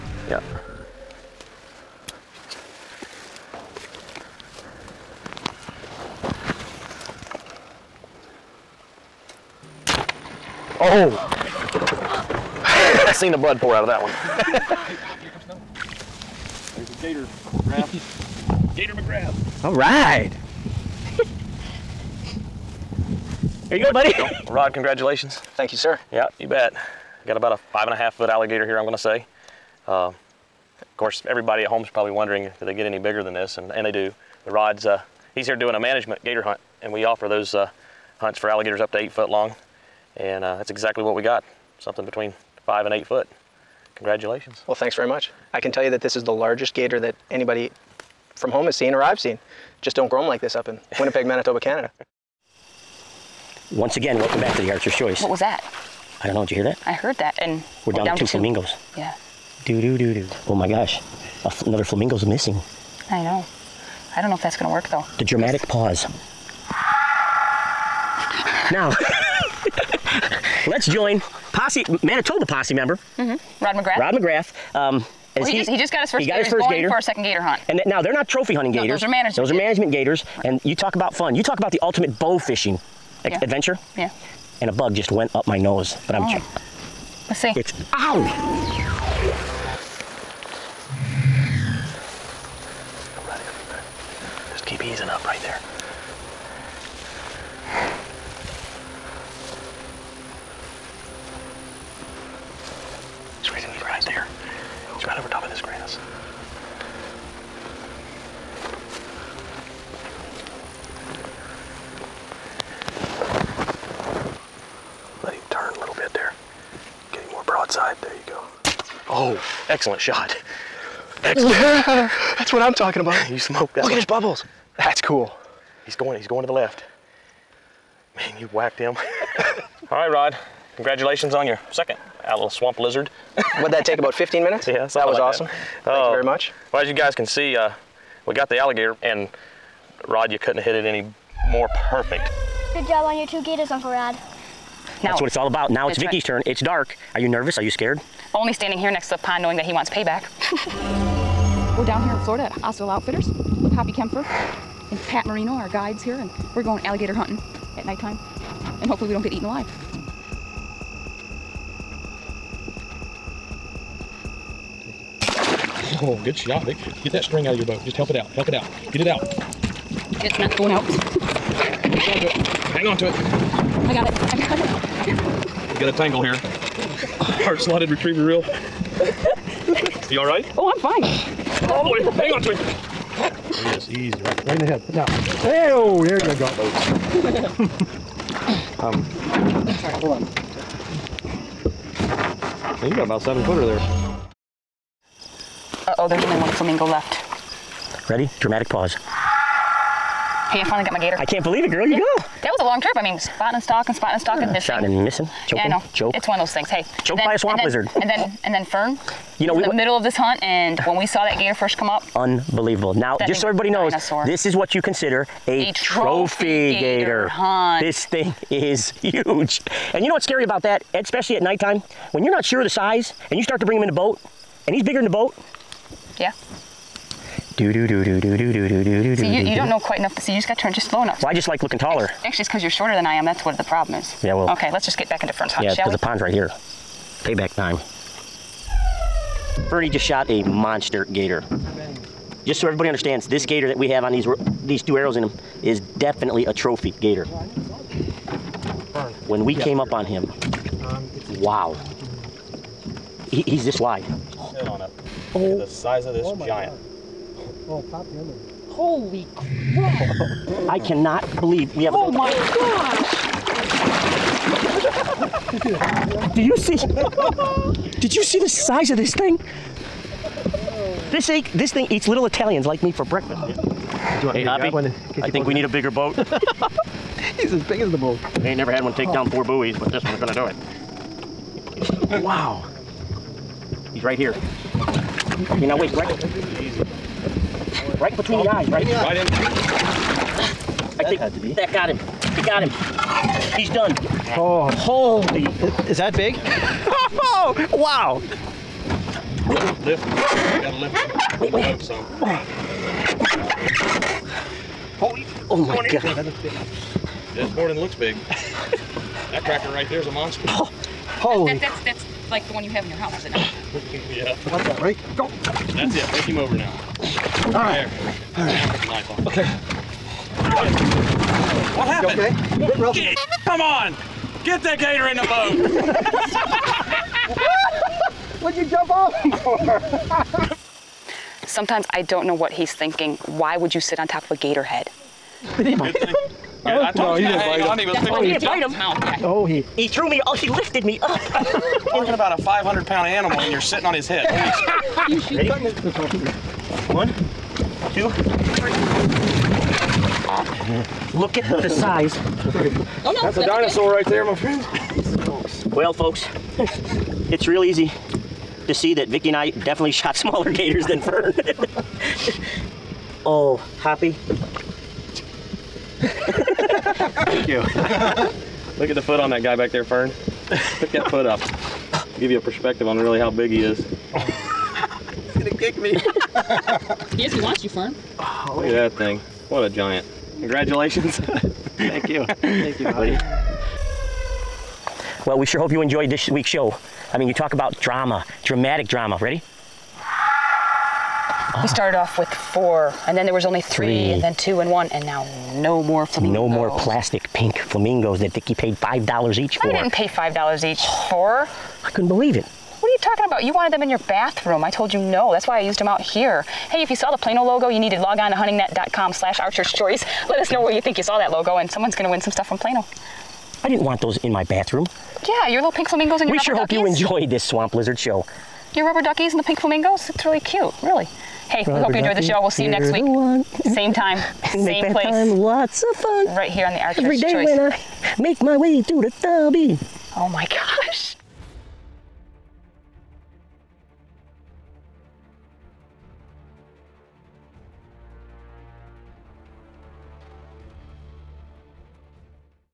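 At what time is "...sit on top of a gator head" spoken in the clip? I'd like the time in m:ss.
5:33.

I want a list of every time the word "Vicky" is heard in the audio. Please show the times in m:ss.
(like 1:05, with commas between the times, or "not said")
2:25, 5:59, 6:38.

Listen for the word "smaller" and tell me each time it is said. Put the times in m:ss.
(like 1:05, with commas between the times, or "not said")
6:00.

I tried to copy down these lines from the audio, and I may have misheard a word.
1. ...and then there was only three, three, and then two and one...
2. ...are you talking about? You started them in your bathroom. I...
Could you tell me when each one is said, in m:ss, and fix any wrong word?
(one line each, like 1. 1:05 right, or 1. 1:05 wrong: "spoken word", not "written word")
1. 6:33 right
2. 6:42 wrong: "wanted", not "started".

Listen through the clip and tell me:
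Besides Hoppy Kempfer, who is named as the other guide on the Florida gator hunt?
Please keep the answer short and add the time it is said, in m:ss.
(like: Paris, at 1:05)
Pat Marino, at 2:35.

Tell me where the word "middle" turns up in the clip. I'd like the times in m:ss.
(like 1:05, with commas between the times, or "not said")
3:29.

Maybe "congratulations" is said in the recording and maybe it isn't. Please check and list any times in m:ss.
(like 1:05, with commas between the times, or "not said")
0:24, 0:43, 2:10, 6:20.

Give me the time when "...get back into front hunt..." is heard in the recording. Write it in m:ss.
3:54.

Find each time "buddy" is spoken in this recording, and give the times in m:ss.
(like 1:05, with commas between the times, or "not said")
0:23, 6:22.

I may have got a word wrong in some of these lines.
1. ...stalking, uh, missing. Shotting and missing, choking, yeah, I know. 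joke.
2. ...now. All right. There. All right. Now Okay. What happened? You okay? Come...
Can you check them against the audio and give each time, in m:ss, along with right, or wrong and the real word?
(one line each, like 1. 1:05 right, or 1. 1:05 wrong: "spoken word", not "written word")
1. 3:24 right
2. 5:16 right.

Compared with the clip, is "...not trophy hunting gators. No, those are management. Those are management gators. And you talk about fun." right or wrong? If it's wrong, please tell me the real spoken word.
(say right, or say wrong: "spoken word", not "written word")
right.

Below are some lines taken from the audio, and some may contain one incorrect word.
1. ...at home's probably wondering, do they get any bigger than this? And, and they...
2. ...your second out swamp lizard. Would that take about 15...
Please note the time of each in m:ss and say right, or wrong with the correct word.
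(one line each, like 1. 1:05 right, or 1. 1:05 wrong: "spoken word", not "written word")
1. 0:31 right
2. 2:11 right.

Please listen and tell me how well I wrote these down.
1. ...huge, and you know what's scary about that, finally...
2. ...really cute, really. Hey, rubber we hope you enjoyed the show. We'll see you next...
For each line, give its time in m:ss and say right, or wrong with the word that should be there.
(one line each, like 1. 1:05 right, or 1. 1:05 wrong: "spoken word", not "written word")
1. 3:39 wrong: "especially", not "finally"
2. 7:00 right.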